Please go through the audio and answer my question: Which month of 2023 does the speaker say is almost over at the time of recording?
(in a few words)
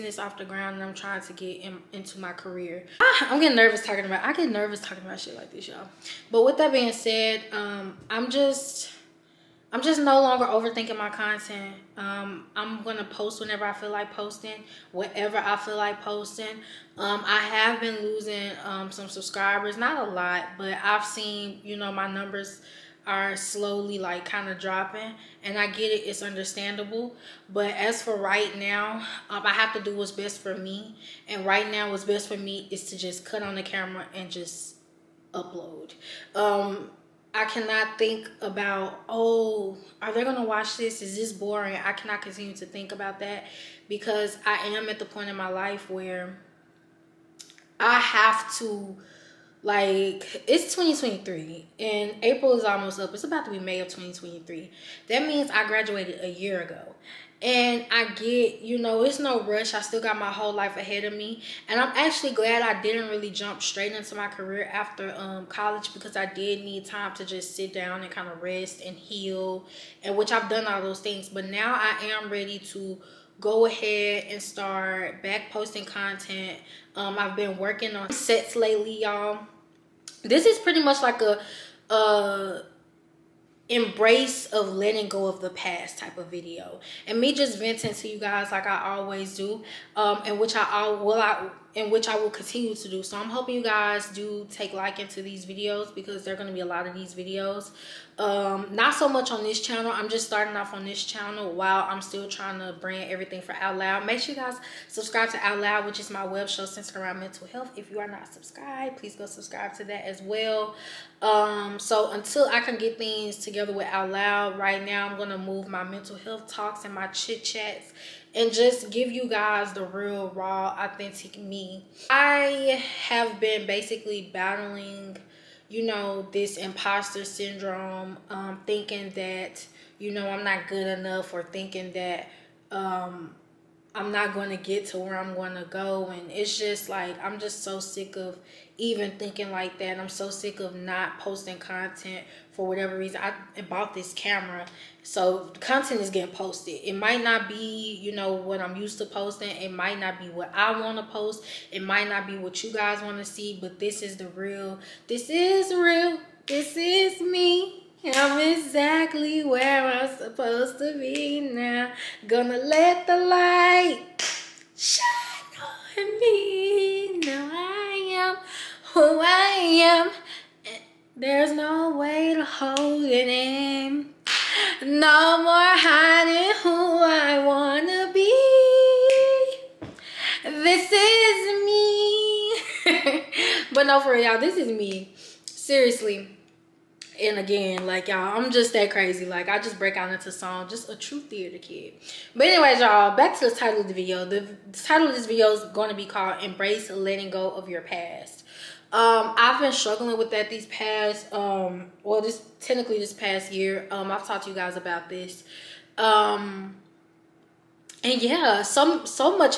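April.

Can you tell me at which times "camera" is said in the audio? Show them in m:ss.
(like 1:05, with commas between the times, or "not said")
0:33, 2:24.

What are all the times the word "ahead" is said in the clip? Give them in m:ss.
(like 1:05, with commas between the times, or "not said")
1:00, 1:13.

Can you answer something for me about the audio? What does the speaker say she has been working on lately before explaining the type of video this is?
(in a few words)
sets.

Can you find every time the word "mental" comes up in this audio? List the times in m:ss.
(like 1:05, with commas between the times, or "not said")
1:47, 1:55.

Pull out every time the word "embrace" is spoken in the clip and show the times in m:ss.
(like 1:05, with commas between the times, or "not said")
1:23, 3:16.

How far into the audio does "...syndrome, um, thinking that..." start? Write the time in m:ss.
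2:07.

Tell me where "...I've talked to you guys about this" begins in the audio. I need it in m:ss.
3:24.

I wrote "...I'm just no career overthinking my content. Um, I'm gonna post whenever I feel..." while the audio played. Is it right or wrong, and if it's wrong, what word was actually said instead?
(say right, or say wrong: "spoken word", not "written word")
wrong: "longer", not "career".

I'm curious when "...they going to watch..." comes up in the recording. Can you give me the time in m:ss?
0:40.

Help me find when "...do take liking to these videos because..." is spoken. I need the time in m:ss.
1:34.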